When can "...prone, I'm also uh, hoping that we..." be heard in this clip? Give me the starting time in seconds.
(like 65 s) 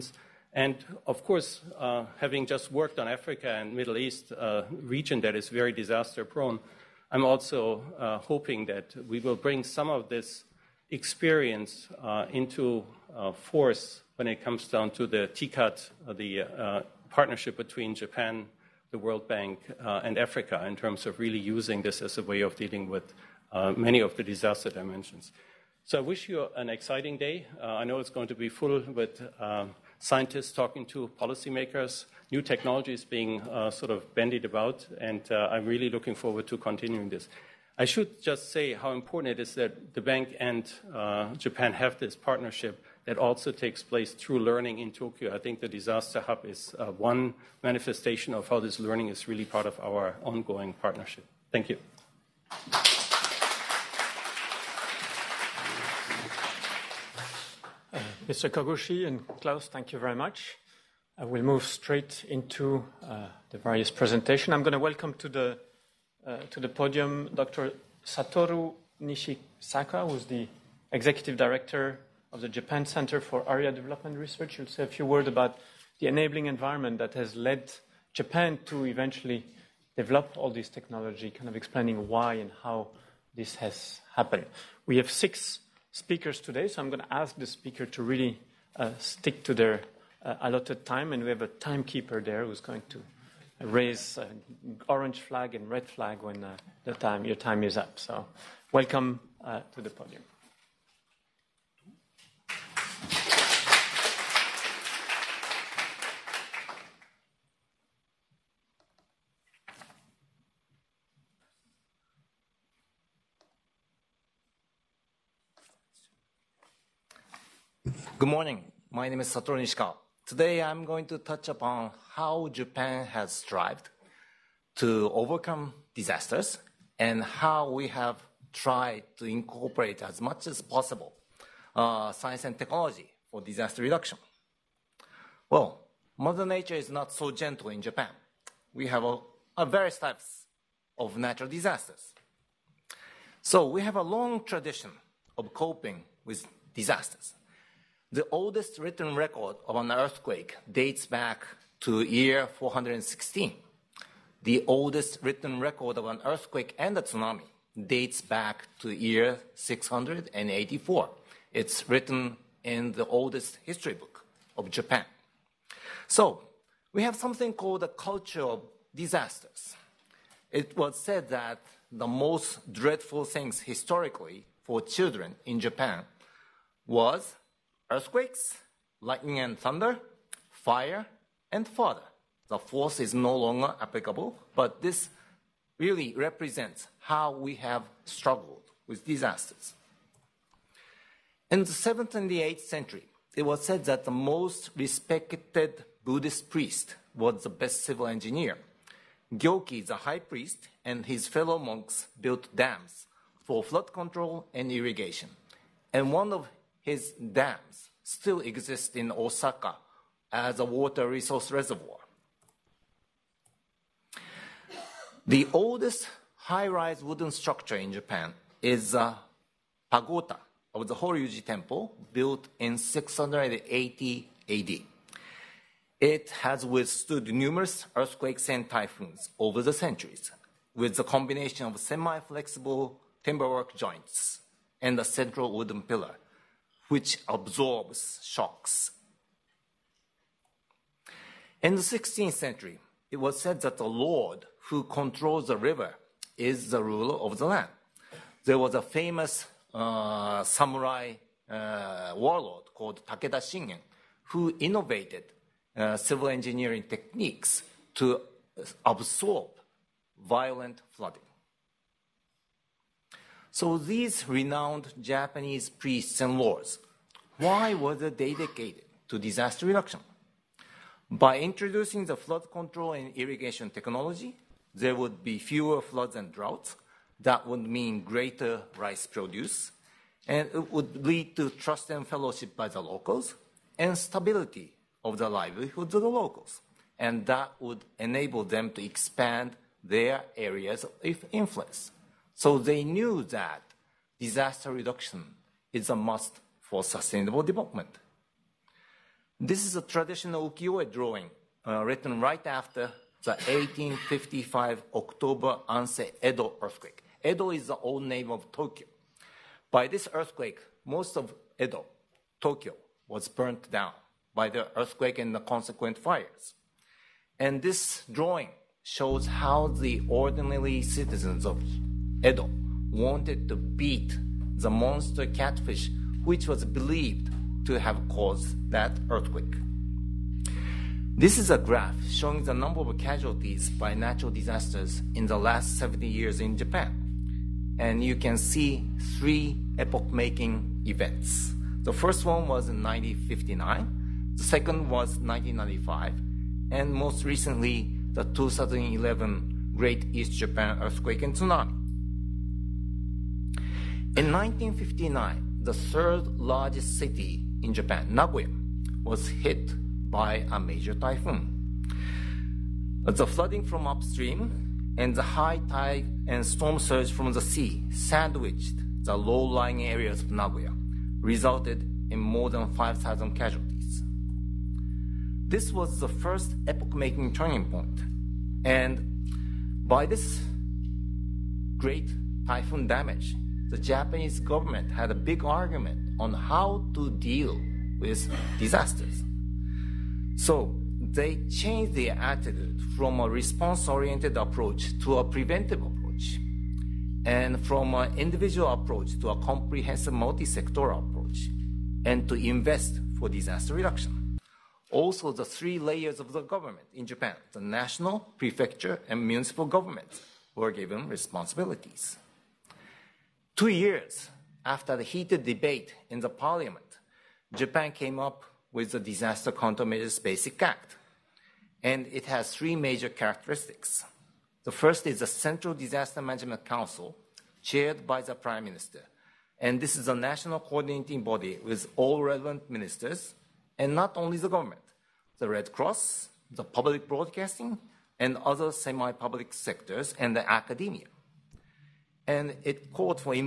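6 s.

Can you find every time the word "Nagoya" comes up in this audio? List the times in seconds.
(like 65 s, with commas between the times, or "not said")
358 s, 370 s.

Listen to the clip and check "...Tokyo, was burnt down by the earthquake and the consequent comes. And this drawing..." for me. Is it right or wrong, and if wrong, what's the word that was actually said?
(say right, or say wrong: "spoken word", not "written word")
wrong: "fires", not "comes".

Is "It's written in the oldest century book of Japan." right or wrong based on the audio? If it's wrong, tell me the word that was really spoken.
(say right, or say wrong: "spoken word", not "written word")
wrong: "history", not "century".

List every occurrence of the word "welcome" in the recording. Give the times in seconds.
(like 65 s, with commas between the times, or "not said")
64 s, 98 s.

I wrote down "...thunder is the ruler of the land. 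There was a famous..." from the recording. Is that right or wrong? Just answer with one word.
wrong.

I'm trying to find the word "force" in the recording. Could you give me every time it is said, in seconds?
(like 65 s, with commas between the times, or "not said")
13 s, 182 s.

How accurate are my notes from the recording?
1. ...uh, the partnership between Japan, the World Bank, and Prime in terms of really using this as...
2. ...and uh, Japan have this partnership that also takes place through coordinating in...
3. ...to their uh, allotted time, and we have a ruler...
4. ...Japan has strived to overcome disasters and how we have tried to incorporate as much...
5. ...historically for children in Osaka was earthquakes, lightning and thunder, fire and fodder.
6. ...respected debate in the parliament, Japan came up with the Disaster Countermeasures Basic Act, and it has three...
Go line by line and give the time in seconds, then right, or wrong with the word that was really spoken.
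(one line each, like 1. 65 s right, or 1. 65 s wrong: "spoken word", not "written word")
1. 16 s wrong: "Africa", not "Prime"
2. 40 s wrong: "learning", not "coordinating"
3. 89 s wrong: "timekeeper", not "ruler"
4. 122 s right
5. 173 s wrong: "Japan", not "Osaka"
6. 415 s wrong: "heated", not "respected".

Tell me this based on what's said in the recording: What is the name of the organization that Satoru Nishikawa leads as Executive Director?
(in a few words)
Japan Center for Area Development Research.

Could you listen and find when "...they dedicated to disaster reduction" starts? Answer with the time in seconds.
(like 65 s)
267 s.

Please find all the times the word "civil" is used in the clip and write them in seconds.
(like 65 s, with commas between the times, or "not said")
197 s, 255 s.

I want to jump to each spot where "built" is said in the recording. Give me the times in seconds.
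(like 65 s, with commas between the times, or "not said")
202 s, 222 s.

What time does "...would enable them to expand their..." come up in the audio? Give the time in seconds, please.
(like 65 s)
287 s.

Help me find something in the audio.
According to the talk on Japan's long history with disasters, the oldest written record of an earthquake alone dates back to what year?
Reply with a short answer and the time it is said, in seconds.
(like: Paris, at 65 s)
416, at 152 s.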